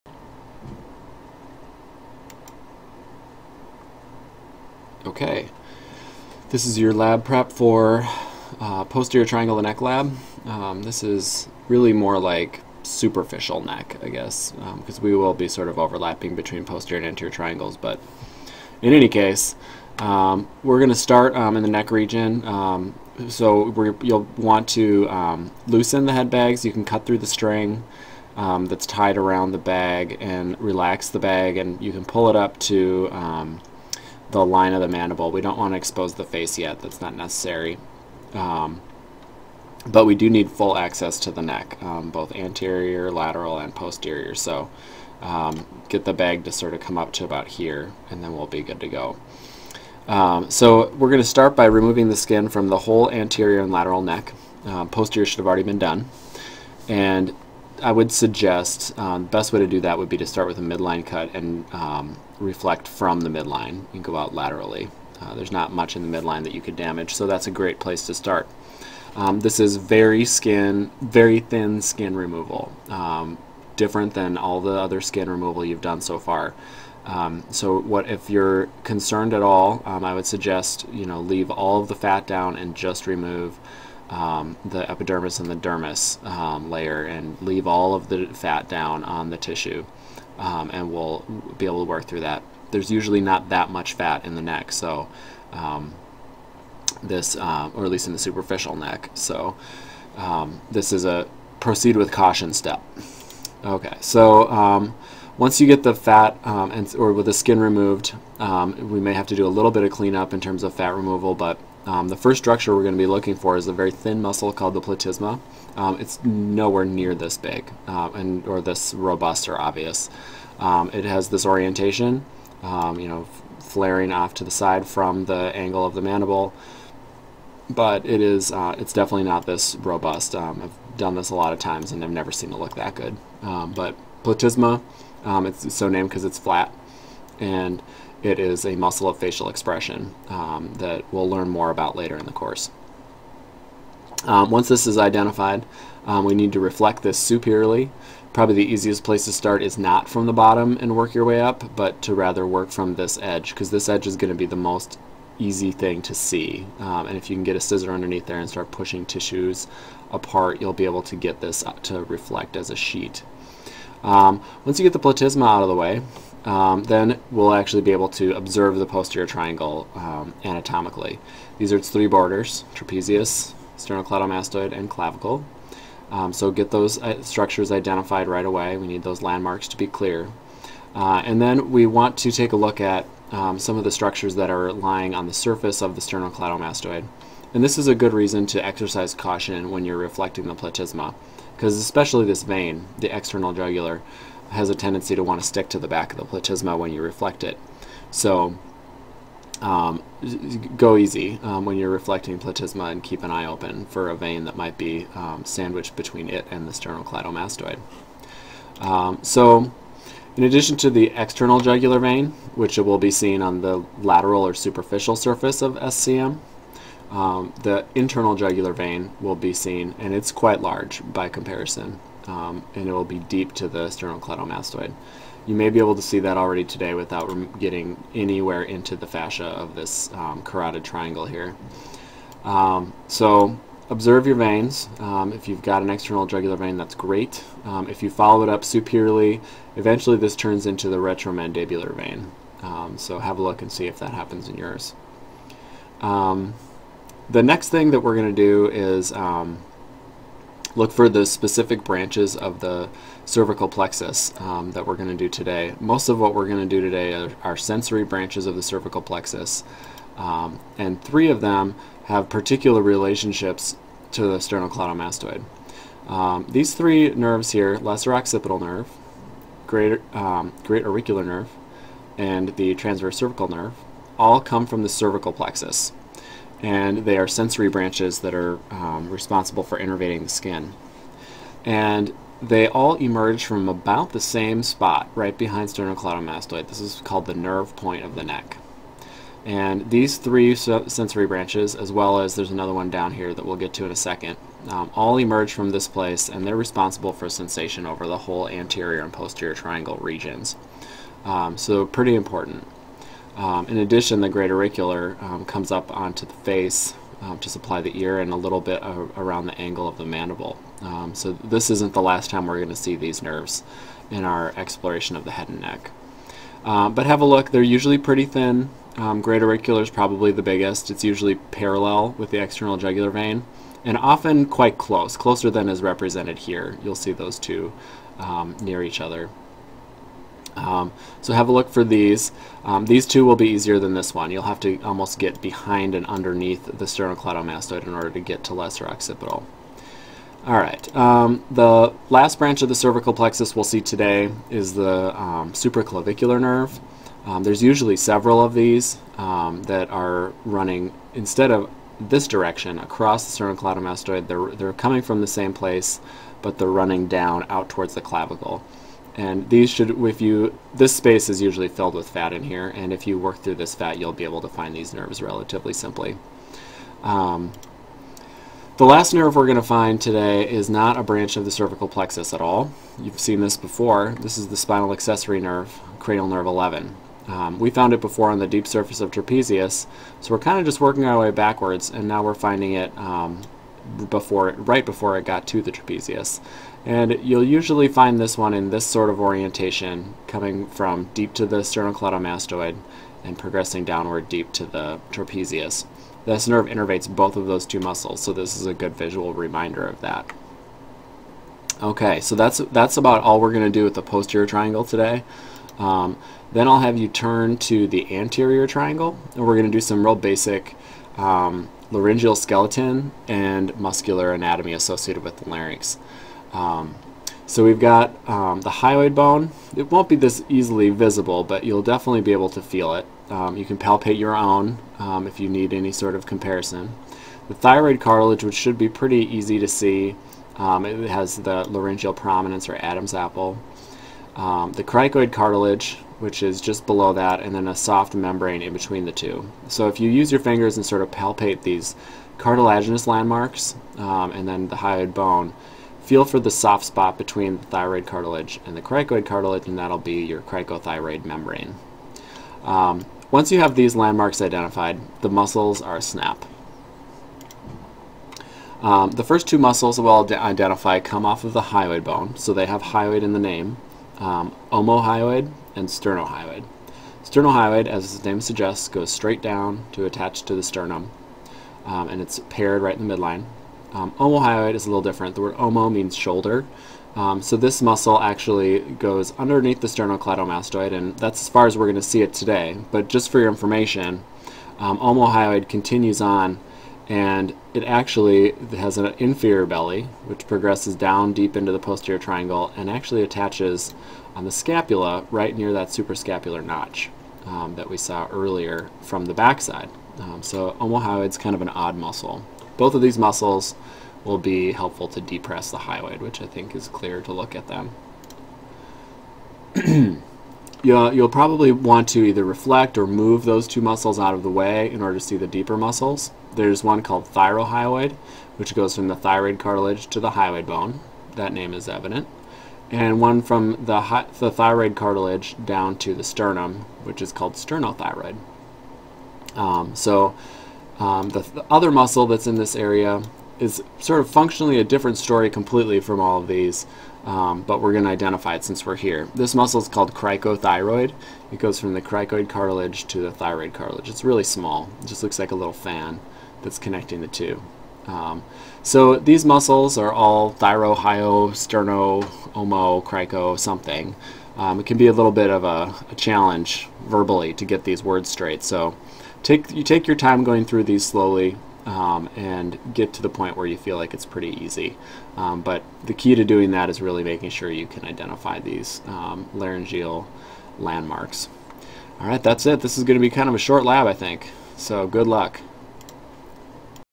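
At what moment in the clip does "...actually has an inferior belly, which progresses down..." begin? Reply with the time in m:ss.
8:07.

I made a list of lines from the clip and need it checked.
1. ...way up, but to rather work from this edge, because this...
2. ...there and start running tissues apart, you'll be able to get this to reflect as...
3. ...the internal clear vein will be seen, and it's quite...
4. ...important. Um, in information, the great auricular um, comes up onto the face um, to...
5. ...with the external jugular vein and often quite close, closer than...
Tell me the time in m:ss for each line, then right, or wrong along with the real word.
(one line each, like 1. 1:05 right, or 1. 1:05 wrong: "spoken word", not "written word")
1. 2:31 right
2. 2:38 wrong: "pushing", not "running"
3. 3:37 wrong: "jugular", not "clear"
4. 5:02 wrong: "addition", not "information"
5. 5:22 right.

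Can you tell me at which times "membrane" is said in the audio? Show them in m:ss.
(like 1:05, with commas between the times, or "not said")
7:18, 7:31.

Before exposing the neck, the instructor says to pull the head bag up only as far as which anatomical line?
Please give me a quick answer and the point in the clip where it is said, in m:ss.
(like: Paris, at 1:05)
Line of the mandible, at 0:34.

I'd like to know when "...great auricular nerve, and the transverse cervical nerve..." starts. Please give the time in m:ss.
4:30.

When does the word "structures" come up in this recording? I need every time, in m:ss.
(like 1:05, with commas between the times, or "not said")
1:52, 2:57, 3:03.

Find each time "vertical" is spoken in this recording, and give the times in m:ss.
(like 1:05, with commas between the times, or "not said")
not said.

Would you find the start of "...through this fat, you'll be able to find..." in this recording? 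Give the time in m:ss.
6:03.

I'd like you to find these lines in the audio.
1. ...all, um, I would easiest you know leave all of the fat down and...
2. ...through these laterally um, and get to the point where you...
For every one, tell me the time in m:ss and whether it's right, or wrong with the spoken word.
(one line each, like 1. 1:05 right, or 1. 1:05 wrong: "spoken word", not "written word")
1. 1:19 wrong: "suggest", not "easiest"
2. 9:20 wrong: "slowly", not "laterally".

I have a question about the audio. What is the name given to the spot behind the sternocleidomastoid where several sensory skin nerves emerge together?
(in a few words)
Nerve point of the neck.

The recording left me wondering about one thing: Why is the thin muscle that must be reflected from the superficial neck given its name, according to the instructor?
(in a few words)
Because it's flat.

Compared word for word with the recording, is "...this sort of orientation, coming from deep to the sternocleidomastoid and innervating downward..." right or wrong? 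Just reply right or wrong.
wrong.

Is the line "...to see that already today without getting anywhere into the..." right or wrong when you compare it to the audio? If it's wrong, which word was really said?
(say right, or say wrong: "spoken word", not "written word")
right.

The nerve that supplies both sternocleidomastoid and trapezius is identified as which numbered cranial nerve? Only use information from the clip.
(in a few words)
11.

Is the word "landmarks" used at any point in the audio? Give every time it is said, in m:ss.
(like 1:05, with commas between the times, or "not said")
2:59, 7:23, 7:33, 9:30.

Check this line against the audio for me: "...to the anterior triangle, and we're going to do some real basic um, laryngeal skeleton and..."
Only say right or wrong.
right.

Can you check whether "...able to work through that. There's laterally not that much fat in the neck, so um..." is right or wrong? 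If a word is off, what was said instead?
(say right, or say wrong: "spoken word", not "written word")
wrong: "usually", not "laterally".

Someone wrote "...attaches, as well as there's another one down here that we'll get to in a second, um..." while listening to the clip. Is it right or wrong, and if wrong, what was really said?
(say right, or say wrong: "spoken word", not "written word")
wrong: "branches", not "attaches".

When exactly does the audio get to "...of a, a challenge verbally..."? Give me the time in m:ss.
9:15.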